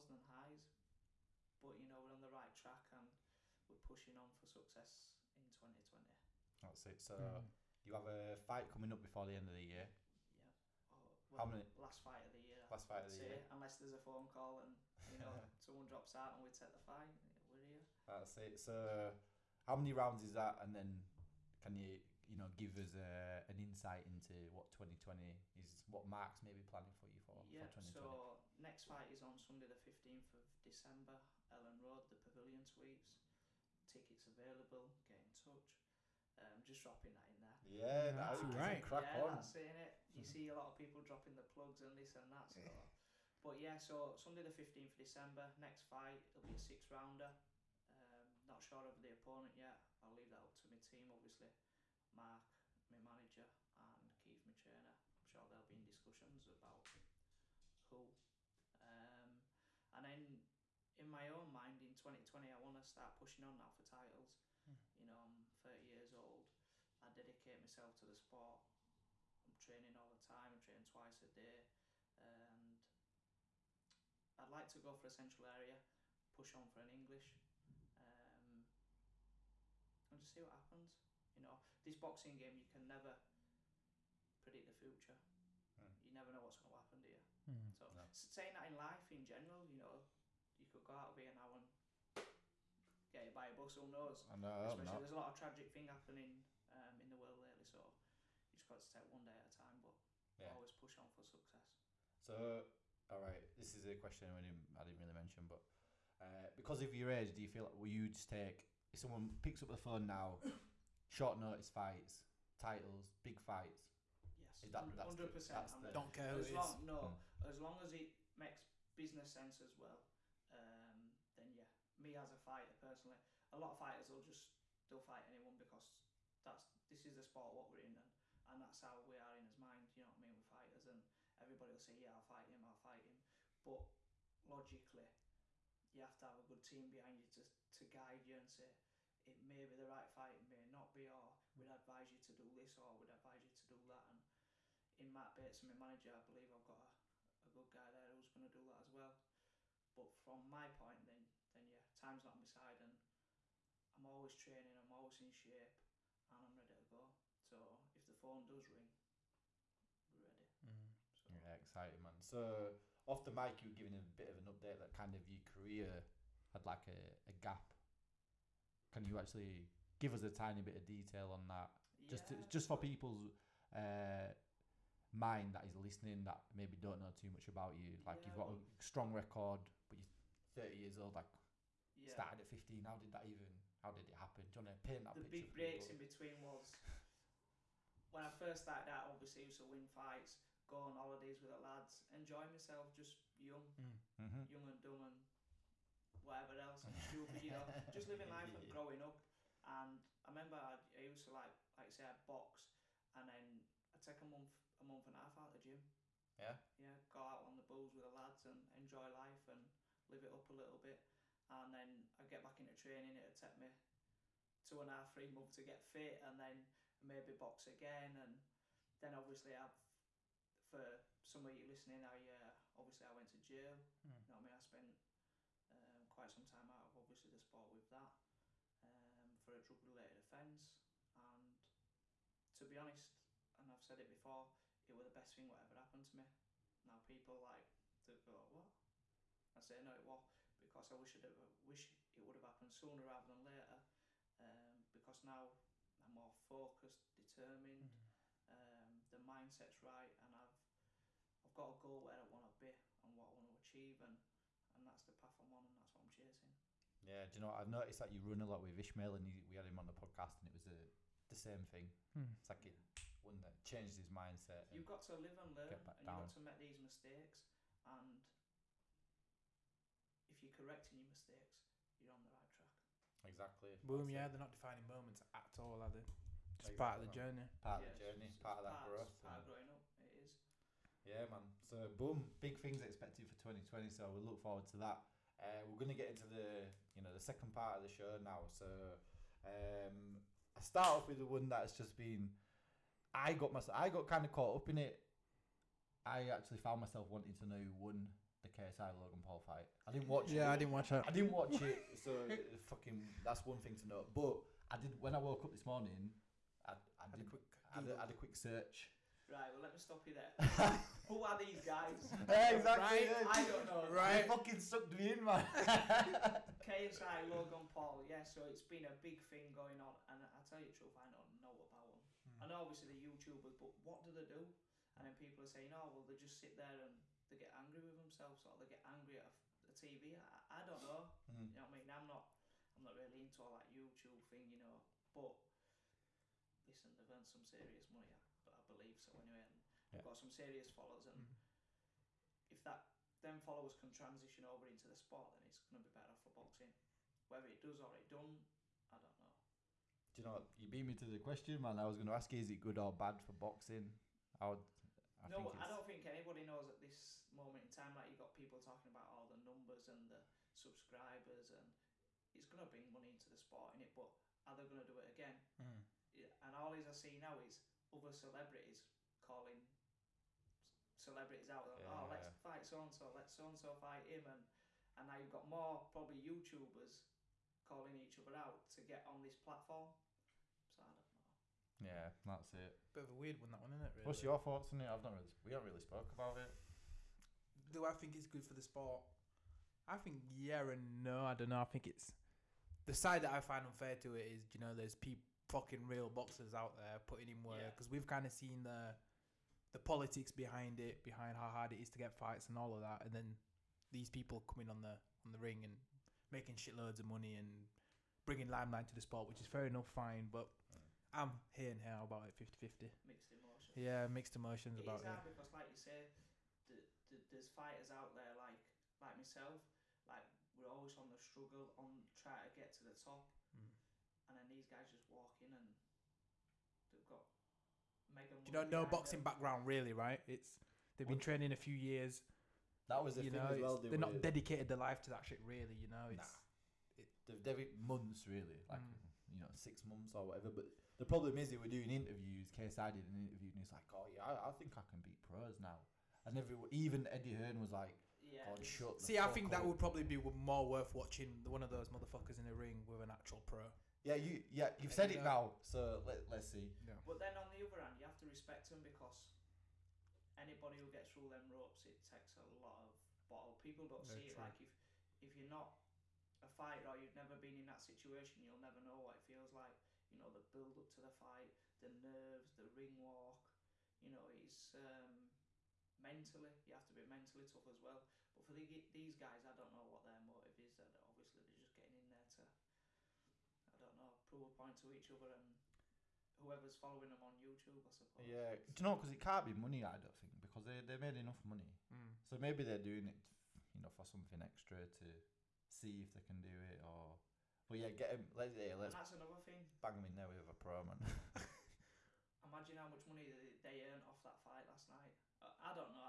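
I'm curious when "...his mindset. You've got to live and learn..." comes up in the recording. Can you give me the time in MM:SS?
04:23.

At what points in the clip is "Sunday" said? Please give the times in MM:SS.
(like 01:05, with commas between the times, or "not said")
00:29, 00:44.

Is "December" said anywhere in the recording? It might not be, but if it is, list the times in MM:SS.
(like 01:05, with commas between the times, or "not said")
00:30, 00:44.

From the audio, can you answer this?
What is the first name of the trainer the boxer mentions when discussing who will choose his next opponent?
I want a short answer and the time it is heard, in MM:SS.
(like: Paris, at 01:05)
Keith, at 00:54.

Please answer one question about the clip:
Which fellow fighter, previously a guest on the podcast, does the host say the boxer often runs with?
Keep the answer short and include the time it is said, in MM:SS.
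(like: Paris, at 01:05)
Ishmael, at 04:18.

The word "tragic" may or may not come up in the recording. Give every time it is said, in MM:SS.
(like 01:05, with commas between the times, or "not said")
01:35.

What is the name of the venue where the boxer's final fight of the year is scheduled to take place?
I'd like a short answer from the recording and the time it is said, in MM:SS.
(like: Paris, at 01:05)
Pavilion Suites, at 00:32.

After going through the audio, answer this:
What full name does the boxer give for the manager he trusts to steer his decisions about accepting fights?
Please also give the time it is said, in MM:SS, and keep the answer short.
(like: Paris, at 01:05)
Matt Bates, at 02:25.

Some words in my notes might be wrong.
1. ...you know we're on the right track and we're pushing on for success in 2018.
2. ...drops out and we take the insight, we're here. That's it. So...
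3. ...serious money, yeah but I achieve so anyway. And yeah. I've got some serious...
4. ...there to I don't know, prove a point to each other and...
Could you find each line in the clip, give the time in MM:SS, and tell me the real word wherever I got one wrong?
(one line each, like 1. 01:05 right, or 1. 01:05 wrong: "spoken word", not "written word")
1. 00:01 wrong: "2020", not "2018"
2. 00:15 wrong: "fight", not "insight"
3. 05:37 wrong: "believe", not "achieve"
4. 08:02 right.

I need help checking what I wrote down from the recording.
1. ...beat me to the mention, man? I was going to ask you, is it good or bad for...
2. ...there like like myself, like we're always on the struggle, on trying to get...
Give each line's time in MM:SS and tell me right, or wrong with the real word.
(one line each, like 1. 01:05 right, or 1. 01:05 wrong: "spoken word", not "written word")
1. 05:50 wrong: "question", not "mention"
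2. 06:58 right.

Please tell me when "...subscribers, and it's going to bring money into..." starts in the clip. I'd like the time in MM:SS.
06:00.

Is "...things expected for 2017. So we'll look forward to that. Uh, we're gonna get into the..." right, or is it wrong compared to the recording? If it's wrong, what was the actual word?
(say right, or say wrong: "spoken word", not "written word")
wrong: "2020", not "2017".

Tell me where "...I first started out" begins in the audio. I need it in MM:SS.
03:08.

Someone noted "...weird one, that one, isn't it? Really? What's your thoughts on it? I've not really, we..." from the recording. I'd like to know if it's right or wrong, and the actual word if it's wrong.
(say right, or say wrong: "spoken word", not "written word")
right.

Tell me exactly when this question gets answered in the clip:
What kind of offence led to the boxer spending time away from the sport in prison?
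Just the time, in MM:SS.
03:49.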